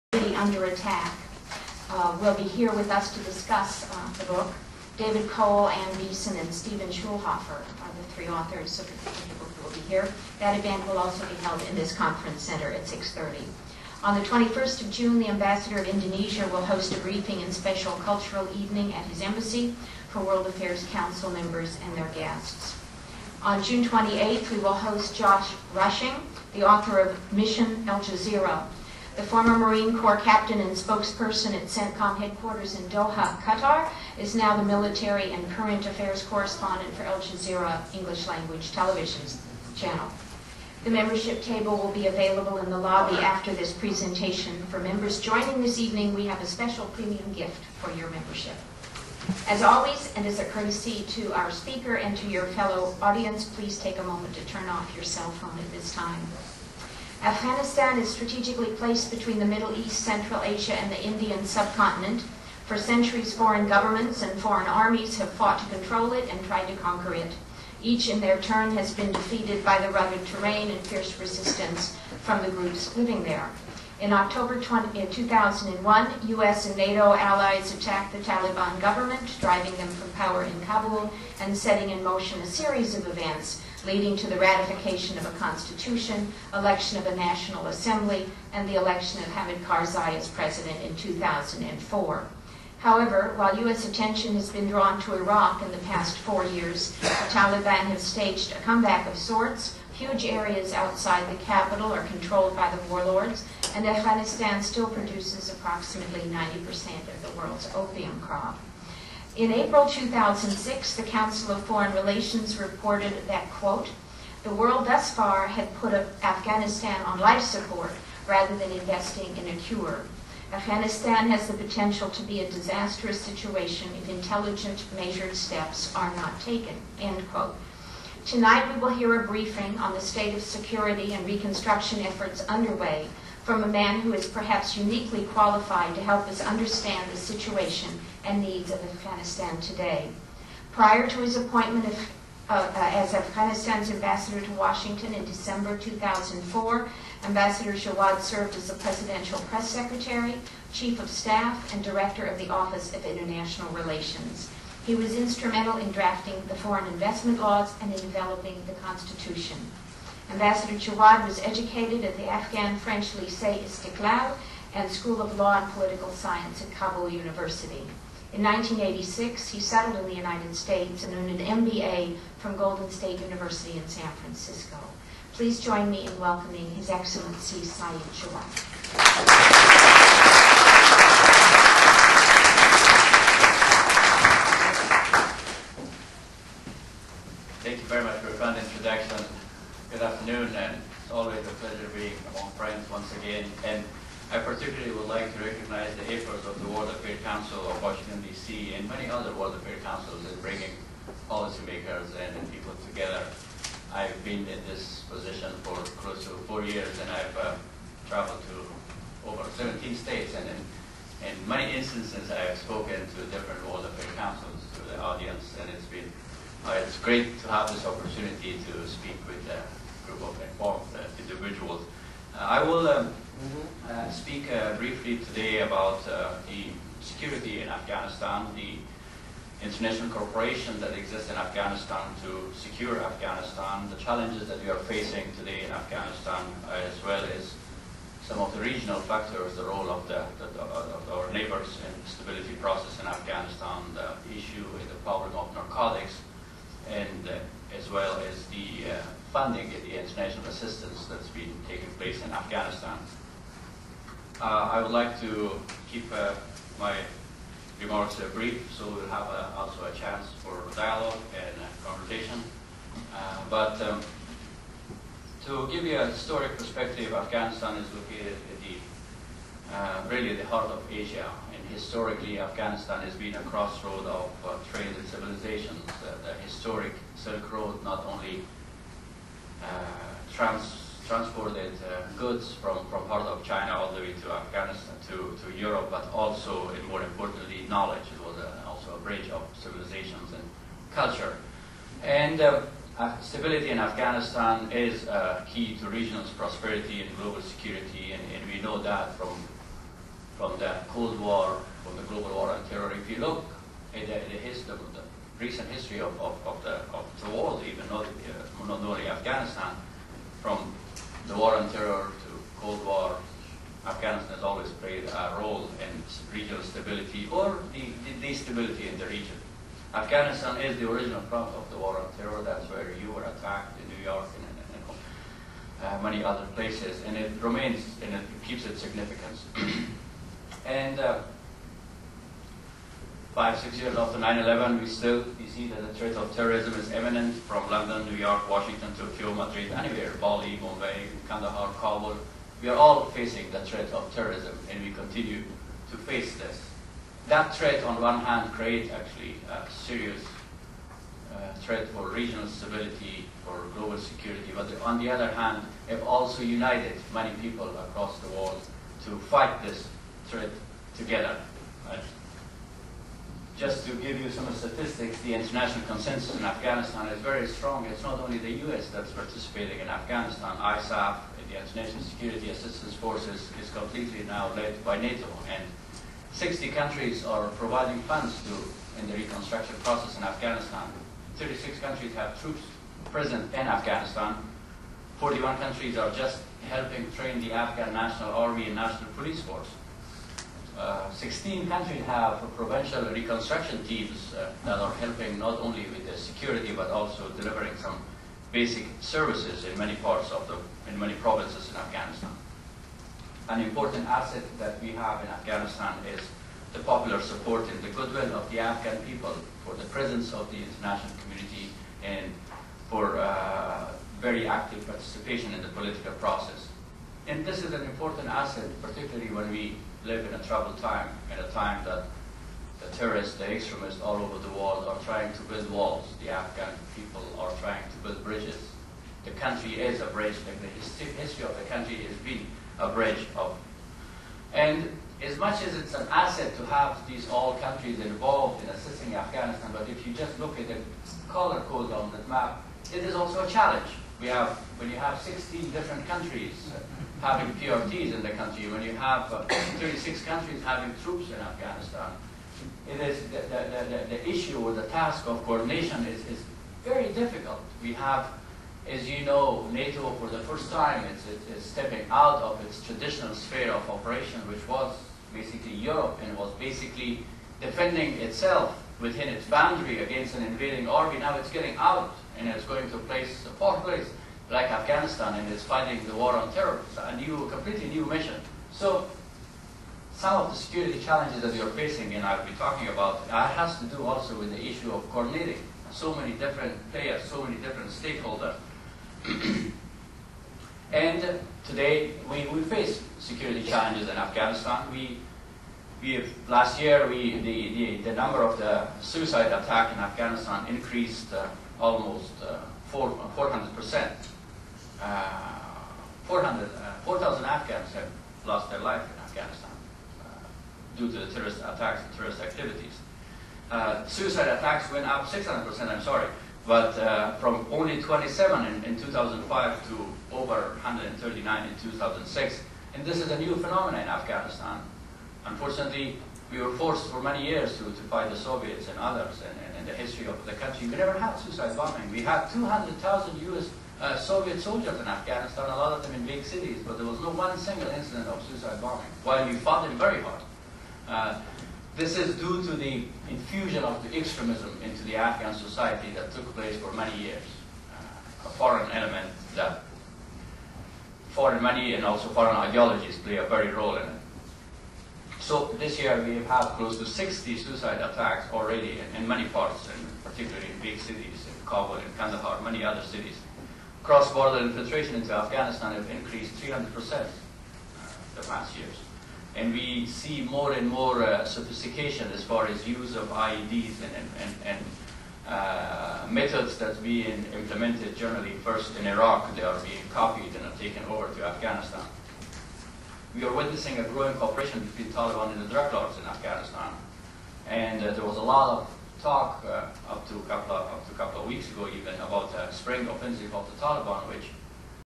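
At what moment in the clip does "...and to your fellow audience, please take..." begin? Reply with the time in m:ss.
0:51.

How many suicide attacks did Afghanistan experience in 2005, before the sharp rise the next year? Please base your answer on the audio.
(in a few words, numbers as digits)
27.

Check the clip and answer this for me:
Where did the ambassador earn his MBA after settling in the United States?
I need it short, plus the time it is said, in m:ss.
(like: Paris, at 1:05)
Golden State University, at 2:52.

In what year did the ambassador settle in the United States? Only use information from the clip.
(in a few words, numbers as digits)
1986.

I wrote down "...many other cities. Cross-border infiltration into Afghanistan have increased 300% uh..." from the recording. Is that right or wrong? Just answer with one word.
right.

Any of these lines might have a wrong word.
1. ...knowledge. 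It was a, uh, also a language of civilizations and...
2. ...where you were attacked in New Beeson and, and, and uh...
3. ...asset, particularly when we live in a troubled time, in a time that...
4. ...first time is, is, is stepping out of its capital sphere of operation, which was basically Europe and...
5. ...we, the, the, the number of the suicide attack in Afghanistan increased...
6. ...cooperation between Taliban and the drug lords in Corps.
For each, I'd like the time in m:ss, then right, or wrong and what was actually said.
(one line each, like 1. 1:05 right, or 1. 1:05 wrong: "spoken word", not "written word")
1. 4:47 wrong: "bridge", not "language"
2. 5:22 wrong: "York", not "Beeson"
3. 6:58 right
4. 7:40 wrong: "traditional", not "capital"
5. 8:17 right
6. 9:44 wrong: "Afghanistan", not "Corps".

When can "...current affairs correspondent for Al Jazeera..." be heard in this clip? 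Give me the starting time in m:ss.
0:35.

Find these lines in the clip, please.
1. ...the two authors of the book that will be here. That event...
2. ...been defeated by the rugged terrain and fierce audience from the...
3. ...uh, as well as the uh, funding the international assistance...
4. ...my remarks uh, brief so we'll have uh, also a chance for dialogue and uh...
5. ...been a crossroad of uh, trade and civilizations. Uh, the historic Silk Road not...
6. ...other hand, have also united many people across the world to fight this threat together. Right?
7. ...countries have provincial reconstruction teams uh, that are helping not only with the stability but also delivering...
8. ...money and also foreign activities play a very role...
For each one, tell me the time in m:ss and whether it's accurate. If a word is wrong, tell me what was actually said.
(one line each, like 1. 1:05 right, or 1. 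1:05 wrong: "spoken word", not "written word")
1. 0:07 wrong: "three", not "two"
2. 1:08 wrong: "resistance", not "audience"
3. 4:07 right
4. 4:16 right
5. 4:33 right
6. 5:55 right
7. 6:31 wrong: "security", not "stability"
8. 9:11 wrong: "ideologies", not "activities".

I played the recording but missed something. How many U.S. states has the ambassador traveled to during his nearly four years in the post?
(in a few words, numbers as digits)
17.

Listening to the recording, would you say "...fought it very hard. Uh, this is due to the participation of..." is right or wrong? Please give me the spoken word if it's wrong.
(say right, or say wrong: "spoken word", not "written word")
wrong: "infusion", not "participation".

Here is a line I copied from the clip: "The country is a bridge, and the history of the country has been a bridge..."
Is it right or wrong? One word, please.
right.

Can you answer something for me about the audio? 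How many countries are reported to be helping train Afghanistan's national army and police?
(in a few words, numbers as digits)
41.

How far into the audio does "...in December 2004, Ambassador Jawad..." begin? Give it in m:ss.
2:25.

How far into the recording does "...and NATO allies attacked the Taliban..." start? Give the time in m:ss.
1:16.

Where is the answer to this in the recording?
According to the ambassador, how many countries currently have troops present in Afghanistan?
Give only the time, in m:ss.
6:21.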